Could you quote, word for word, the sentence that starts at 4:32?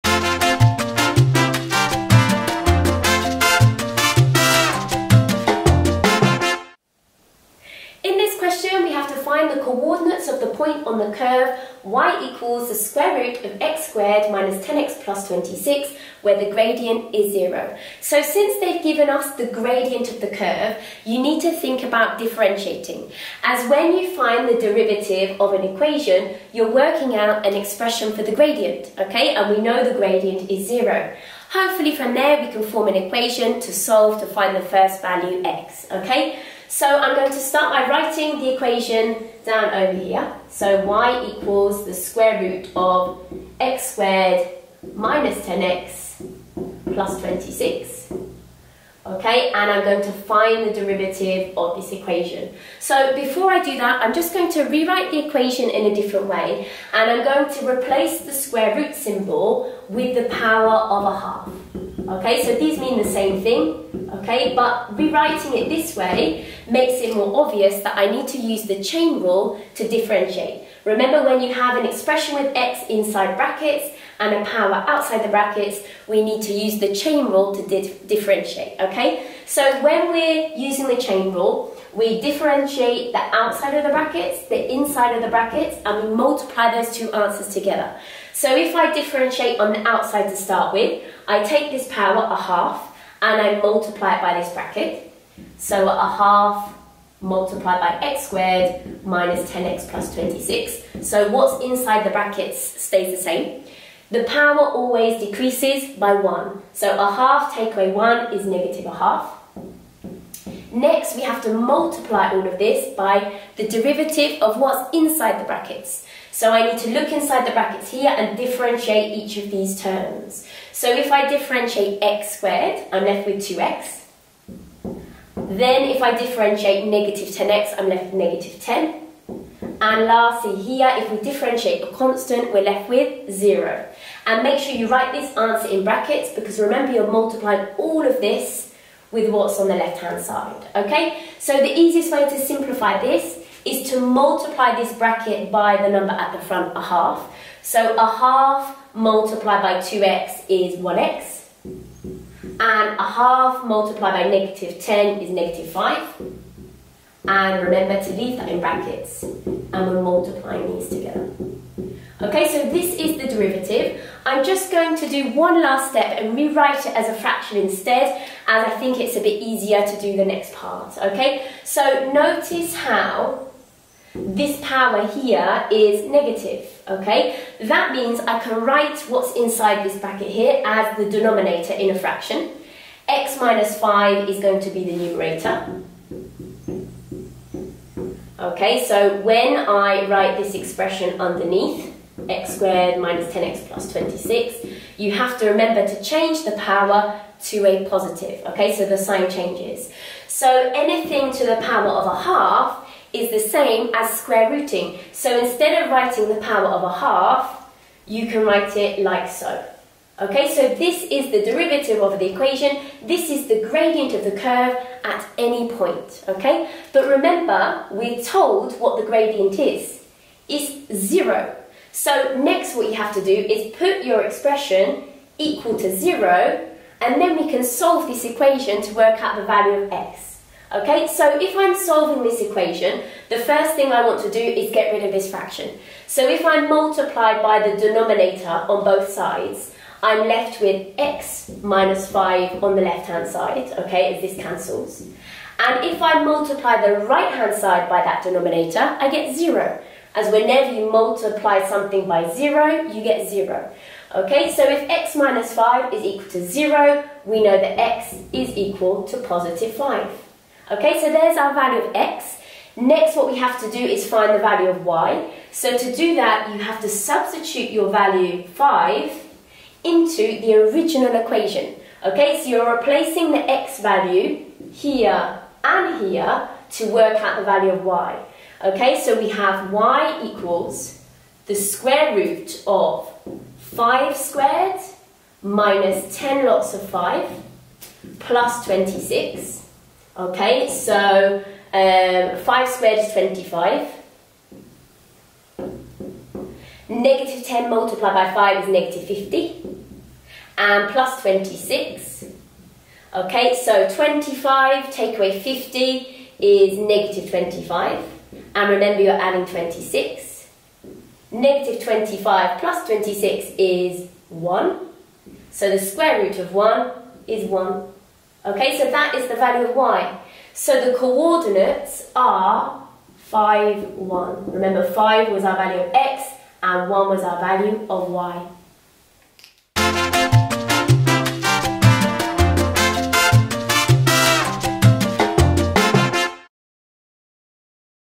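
Okay, so you're replacing the x value here and here to work out the value of y.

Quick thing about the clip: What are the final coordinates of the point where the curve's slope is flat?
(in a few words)
(5, 1).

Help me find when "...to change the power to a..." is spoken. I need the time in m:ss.
3:15.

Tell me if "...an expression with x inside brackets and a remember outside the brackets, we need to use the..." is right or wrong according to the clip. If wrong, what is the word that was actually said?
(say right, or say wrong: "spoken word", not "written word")
wrong: "power", not "remember".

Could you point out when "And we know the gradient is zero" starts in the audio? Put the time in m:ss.
0:29.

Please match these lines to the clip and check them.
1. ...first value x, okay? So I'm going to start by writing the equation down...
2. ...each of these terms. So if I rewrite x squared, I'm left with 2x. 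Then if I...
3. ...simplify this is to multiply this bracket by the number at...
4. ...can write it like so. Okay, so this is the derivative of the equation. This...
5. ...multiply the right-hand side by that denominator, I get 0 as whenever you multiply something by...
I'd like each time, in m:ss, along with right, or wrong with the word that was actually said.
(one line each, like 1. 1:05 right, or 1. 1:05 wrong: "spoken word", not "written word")
1. 0:34 right
2. 1:59 wrong: "differentiate", not "rewrite"
3. 2:22 right
4. 3:28 right
5. 4:06 right.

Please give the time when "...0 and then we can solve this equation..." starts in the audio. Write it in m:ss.
3:45.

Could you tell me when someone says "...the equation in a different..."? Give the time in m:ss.
0:55.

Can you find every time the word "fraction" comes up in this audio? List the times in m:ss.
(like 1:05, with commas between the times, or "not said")
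2:47, 3:01, 3:55.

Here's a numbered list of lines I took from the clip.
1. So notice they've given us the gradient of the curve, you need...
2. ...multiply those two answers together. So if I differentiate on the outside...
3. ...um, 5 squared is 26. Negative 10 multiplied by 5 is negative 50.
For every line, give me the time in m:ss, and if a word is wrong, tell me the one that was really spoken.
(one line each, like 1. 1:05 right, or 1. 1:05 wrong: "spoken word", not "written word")
1. 0:17 wrong: "since", not "notice"
2. 1:26 right
3. 4:51 wrong: "25", not "26".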